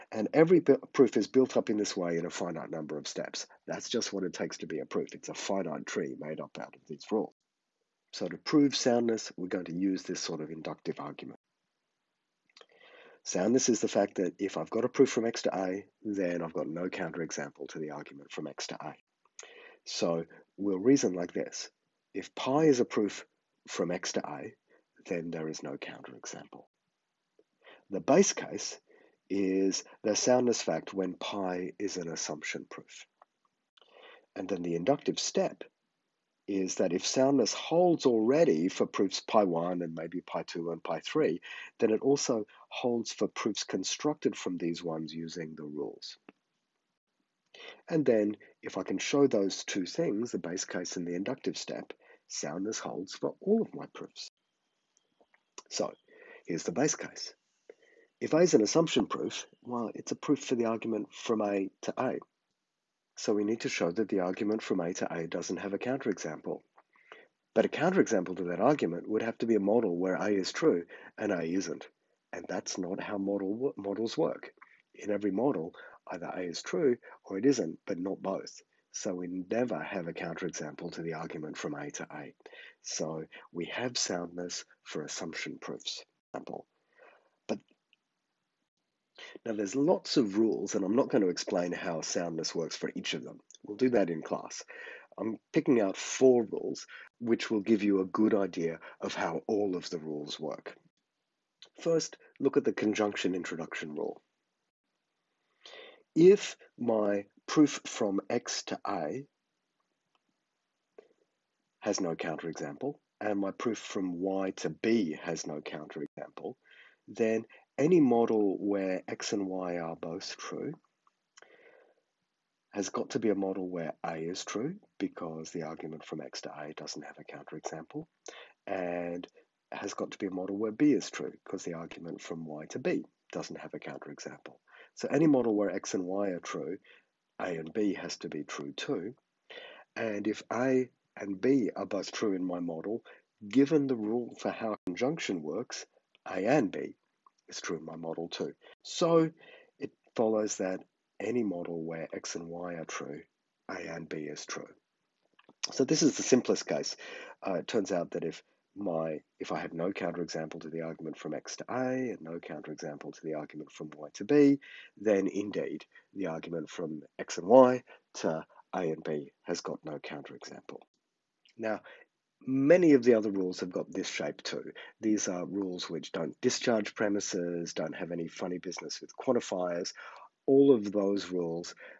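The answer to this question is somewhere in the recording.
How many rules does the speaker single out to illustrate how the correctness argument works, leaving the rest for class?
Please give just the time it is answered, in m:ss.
1:35.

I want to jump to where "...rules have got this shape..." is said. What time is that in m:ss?
2:53.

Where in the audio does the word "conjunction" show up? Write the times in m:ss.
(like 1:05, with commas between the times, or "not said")
1:42, 2:24.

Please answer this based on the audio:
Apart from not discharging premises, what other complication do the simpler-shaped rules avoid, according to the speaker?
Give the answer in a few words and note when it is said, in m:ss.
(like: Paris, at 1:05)
Quantifiers, at 2:59.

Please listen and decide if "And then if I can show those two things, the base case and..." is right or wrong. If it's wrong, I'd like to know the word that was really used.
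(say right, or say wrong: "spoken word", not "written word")
right.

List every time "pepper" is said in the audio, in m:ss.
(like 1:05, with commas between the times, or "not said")
not said.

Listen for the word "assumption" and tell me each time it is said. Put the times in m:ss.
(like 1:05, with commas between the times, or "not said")
0:32, 0:58, 1:25.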